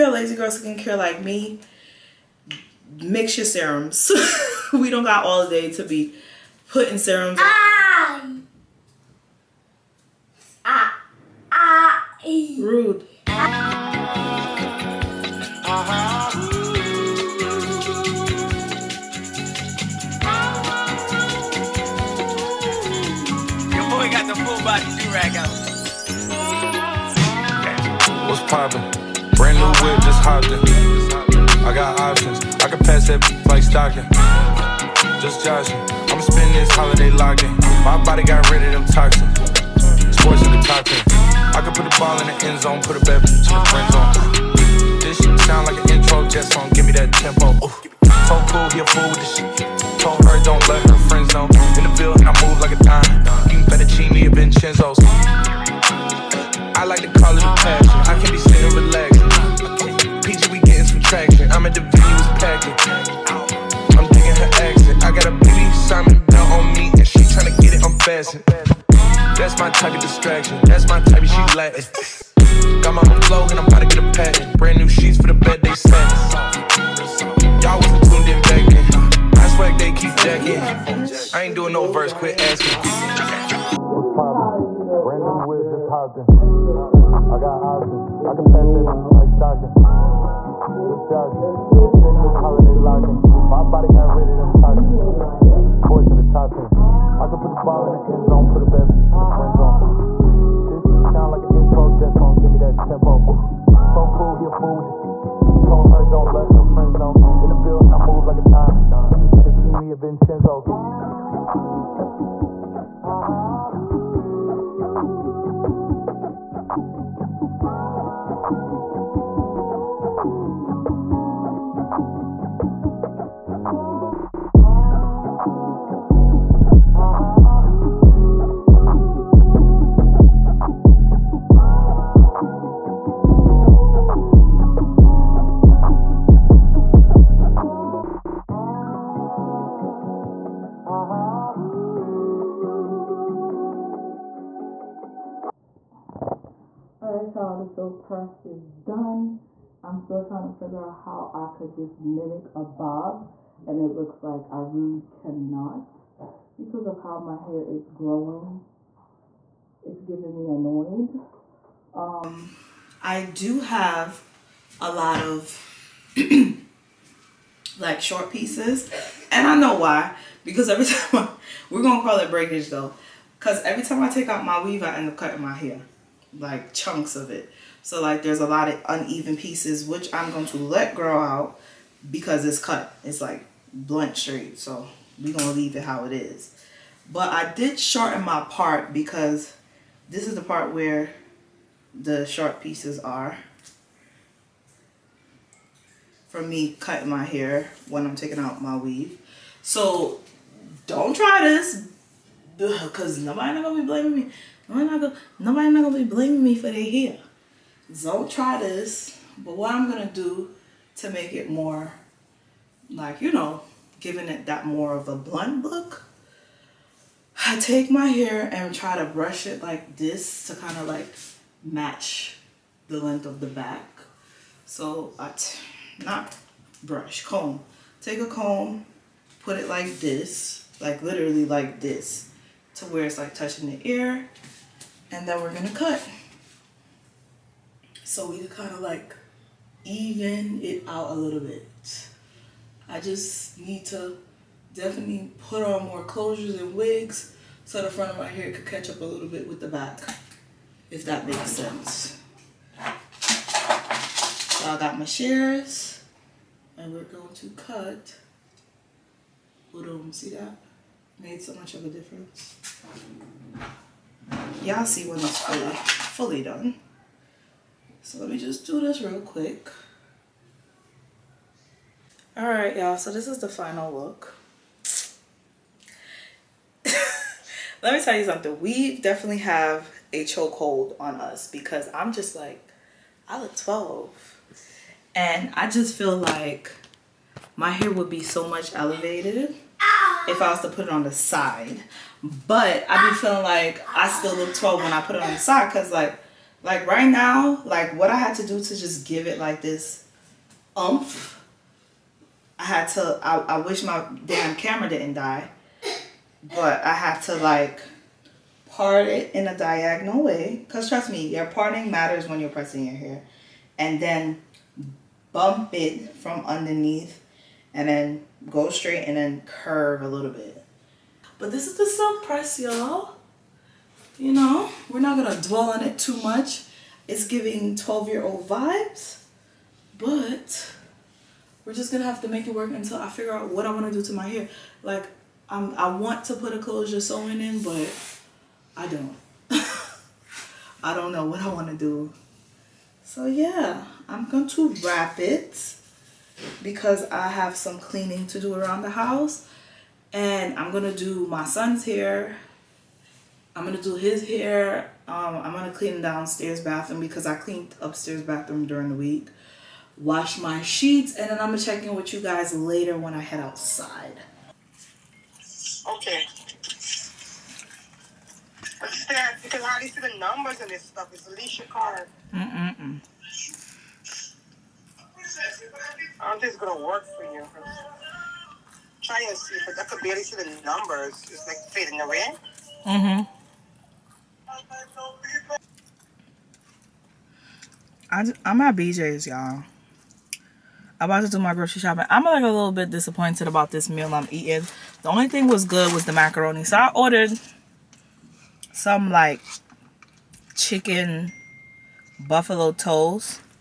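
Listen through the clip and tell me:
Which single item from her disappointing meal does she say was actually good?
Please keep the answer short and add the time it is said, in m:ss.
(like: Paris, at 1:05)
Macaroni, at 6:36.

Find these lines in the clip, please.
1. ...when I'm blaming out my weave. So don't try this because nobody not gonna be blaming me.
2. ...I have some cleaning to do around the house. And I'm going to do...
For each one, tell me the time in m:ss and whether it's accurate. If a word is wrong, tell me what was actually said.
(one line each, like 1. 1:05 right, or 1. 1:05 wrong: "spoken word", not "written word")
1. 3:17 wrong: "taking", not "blaming"
2. 5:47 right.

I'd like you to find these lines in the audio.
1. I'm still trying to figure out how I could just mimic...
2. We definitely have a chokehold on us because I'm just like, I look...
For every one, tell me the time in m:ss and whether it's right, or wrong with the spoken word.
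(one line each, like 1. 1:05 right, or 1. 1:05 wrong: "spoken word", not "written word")
1. 2:29 right
2. 4:38 right.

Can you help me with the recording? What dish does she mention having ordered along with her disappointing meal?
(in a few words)
Chicken buffalo toast.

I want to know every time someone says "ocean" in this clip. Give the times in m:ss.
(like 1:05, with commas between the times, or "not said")
not said.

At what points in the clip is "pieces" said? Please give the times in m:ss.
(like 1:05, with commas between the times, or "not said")
2:48, 2:59, 3:12.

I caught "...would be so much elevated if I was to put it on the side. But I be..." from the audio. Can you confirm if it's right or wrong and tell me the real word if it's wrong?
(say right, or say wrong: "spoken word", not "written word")
right.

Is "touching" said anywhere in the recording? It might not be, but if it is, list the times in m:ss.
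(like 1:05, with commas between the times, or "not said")
3:53.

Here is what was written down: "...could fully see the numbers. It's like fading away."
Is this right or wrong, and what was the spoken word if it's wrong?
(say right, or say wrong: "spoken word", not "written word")
wrong: "barely", not "fully".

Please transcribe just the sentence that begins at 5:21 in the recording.
But this is the silk press, y'all you know, we're not going to dwell on it too much.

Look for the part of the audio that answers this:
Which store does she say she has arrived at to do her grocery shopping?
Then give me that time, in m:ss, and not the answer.
6:28.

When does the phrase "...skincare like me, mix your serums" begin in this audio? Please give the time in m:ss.
0:00.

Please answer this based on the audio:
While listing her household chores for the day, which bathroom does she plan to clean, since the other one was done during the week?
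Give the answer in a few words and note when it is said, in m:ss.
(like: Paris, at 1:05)
Downstairs bathroom, at 5:56.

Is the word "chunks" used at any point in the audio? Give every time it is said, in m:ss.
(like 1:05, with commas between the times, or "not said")
2:56.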